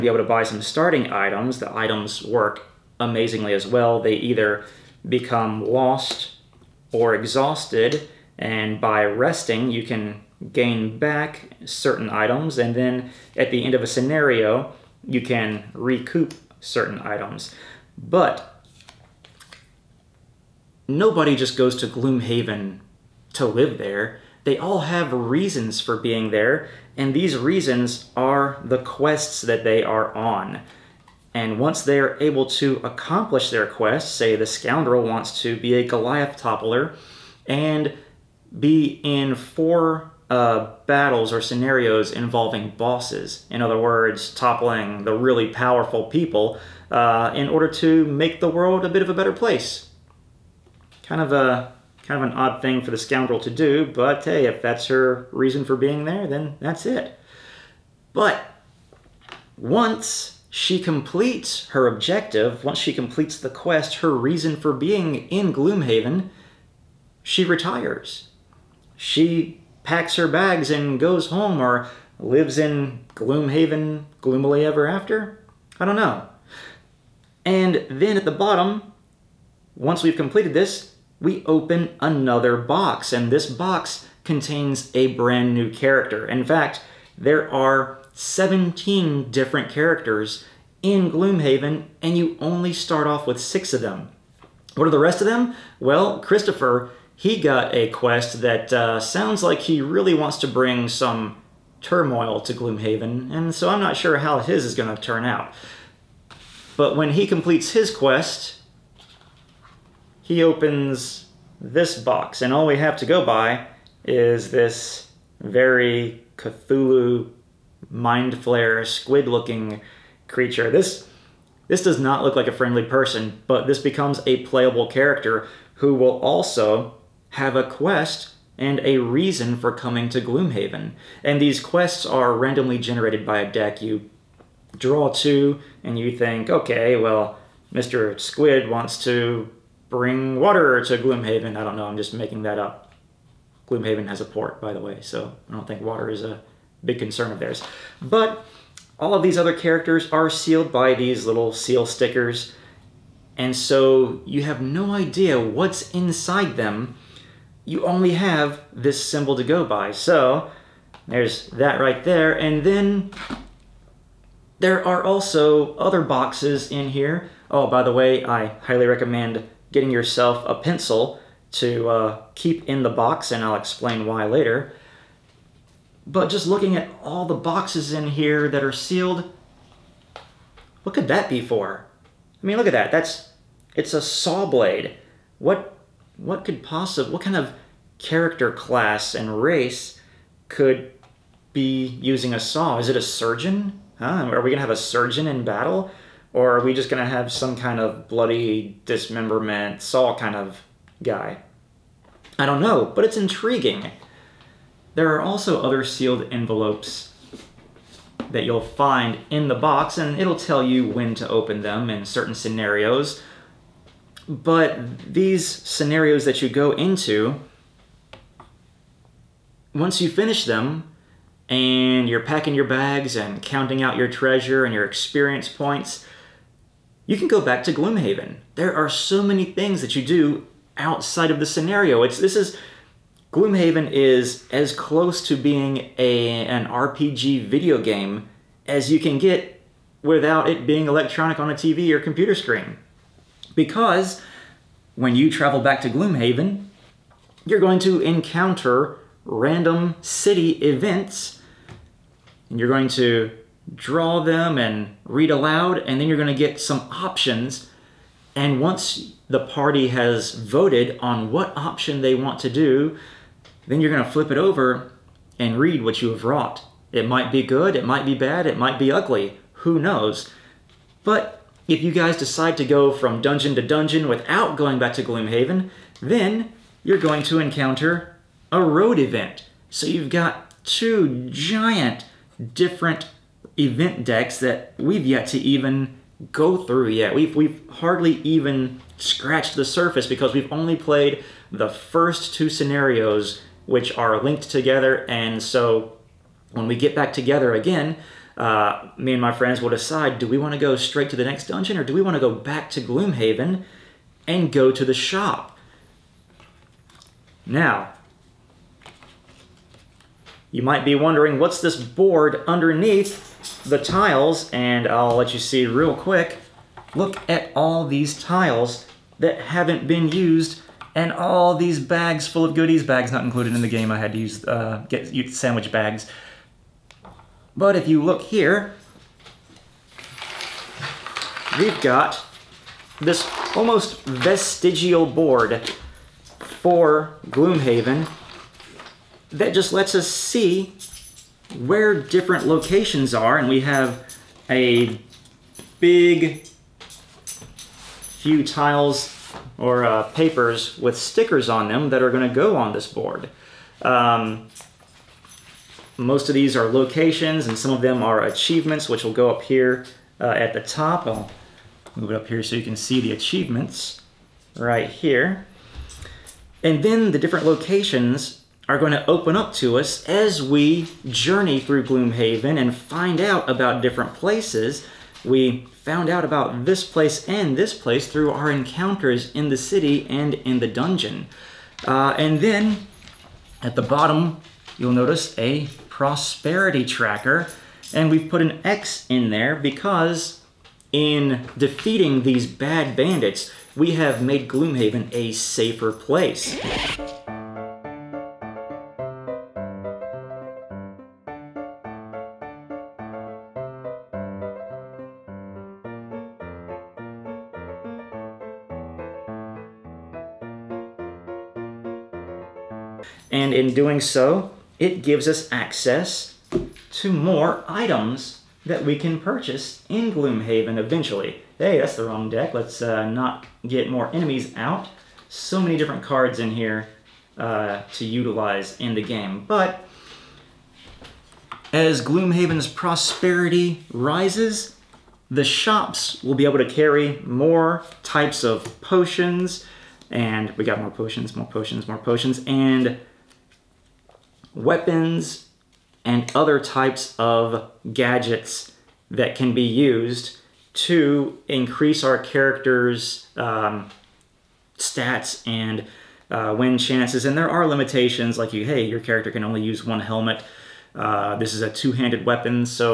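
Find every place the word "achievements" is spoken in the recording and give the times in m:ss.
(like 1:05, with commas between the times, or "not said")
5:58, 6:03.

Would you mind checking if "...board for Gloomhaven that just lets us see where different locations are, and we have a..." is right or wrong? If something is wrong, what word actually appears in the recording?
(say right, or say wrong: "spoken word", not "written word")
right.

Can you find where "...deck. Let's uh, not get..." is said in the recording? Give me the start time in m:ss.
7:02.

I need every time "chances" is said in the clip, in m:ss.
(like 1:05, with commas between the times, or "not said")
7:36.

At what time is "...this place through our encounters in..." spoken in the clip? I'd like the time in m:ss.
6:17.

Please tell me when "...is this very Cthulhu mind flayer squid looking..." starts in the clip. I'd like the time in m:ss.
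1:54.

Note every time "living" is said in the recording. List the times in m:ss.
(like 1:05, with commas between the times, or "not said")
not said.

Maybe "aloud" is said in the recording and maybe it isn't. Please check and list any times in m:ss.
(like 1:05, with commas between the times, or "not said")
4:15.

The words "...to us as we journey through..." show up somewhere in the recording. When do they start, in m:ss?
6:09.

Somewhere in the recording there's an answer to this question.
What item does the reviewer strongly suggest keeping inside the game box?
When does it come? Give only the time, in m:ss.
2:50.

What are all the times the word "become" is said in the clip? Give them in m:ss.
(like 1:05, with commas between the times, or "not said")
0:05, 2:03.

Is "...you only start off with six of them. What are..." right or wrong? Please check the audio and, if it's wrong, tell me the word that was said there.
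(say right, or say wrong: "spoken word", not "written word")
right.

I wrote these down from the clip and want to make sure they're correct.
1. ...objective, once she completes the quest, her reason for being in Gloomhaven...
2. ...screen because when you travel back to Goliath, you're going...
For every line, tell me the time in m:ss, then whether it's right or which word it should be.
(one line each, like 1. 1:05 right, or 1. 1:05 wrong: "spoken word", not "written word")
1. 1:01 right
2. 4:02 wrong: "Gloomhaven", not "Goliath".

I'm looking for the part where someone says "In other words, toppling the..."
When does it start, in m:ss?
0:43.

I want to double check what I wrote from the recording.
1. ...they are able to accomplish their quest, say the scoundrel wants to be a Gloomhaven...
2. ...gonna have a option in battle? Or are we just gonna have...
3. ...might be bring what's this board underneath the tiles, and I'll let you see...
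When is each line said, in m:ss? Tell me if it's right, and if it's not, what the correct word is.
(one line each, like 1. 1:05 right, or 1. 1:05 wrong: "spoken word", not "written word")
1. 0:31 wrong: "Goliath", not "Gloomhaven"
2. 3:14 wrong: "surgeon", not "option"
3. 5:10 wrong: "wondering", not "bring".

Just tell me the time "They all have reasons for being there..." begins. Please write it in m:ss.
0:24.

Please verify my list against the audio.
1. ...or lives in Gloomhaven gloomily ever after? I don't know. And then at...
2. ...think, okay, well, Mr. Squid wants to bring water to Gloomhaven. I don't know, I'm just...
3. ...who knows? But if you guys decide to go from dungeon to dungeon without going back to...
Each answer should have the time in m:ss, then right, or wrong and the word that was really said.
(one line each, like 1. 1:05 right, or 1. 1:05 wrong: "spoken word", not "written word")
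1. 1:11 right
2. 2:16 right
3. 4:29 right.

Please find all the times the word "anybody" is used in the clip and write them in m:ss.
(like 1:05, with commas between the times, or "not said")
not said.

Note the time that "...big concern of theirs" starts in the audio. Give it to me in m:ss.
2:26.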